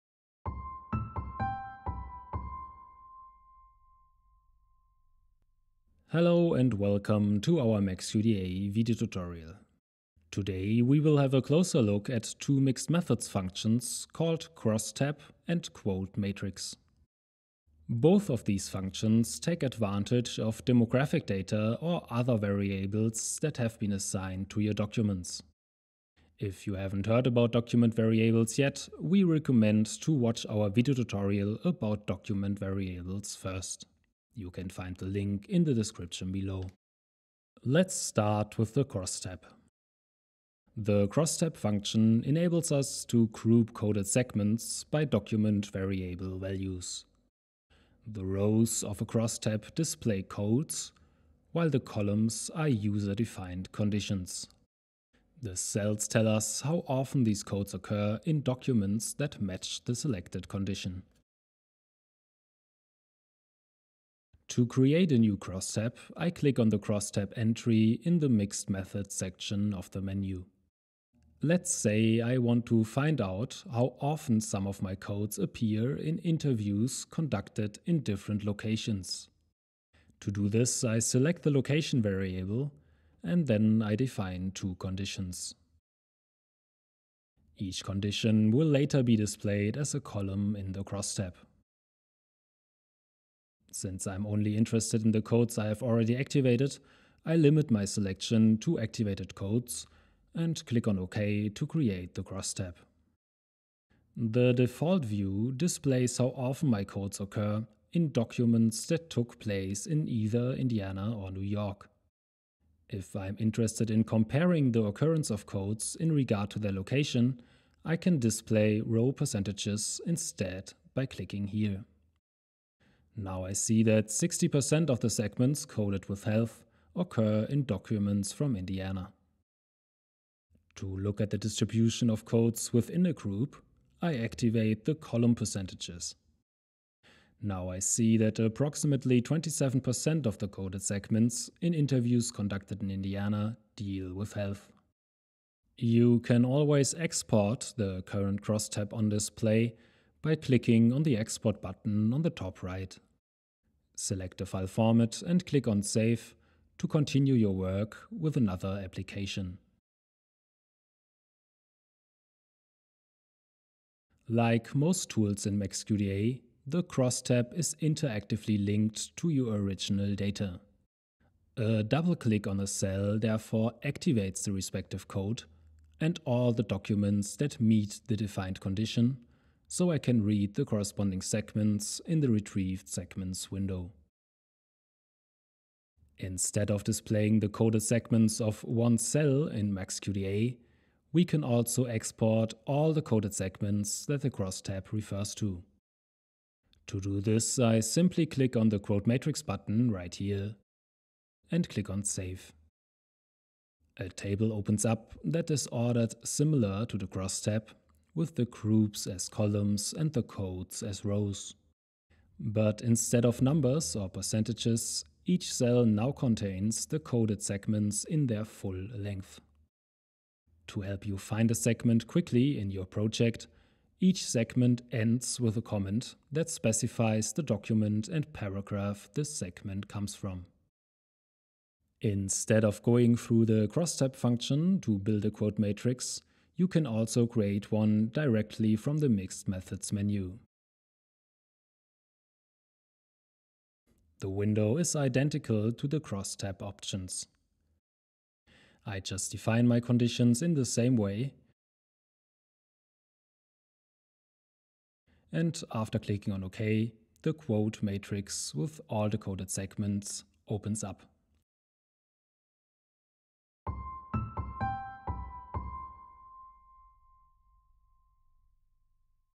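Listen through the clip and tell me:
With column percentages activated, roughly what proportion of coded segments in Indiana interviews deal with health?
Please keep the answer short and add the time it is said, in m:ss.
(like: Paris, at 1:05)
27%, at 2:19.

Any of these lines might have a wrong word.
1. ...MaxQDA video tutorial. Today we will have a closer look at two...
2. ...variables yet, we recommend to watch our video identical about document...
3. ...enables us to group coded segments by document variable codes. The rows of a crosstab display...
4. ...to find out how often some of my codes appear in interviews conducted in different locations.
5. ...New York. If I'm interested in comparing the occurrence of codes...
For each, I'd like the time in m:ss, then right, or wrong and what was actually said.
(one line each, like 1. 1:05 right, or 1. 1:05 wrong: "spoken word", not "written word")
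1. 0:07 right
2. 0:27 wrong: "tutorial", not "identical"
3. 0:42 wrong: "values", not "codes"
4. 1:12 right
5. 1:51 right.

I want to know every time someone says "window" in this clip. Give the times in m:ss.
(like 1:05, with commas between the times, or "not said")
3:03, 4:04.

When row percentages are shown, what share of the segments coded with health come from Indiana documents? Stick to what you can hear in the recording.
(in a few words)
60%.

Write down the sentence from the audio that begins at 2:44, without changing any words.
Like most tools in MaxQDA, the cross tab is interactively linked to your original data.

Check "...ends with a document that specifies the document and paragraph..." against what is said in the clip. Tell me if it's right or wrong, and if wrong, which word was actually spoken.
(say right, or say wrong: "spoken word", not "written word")
wrong: "comment", not "document".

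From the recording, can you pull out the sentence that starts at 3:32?
But instead of numbers or percentages, each cell now contains the coded segments in their full length.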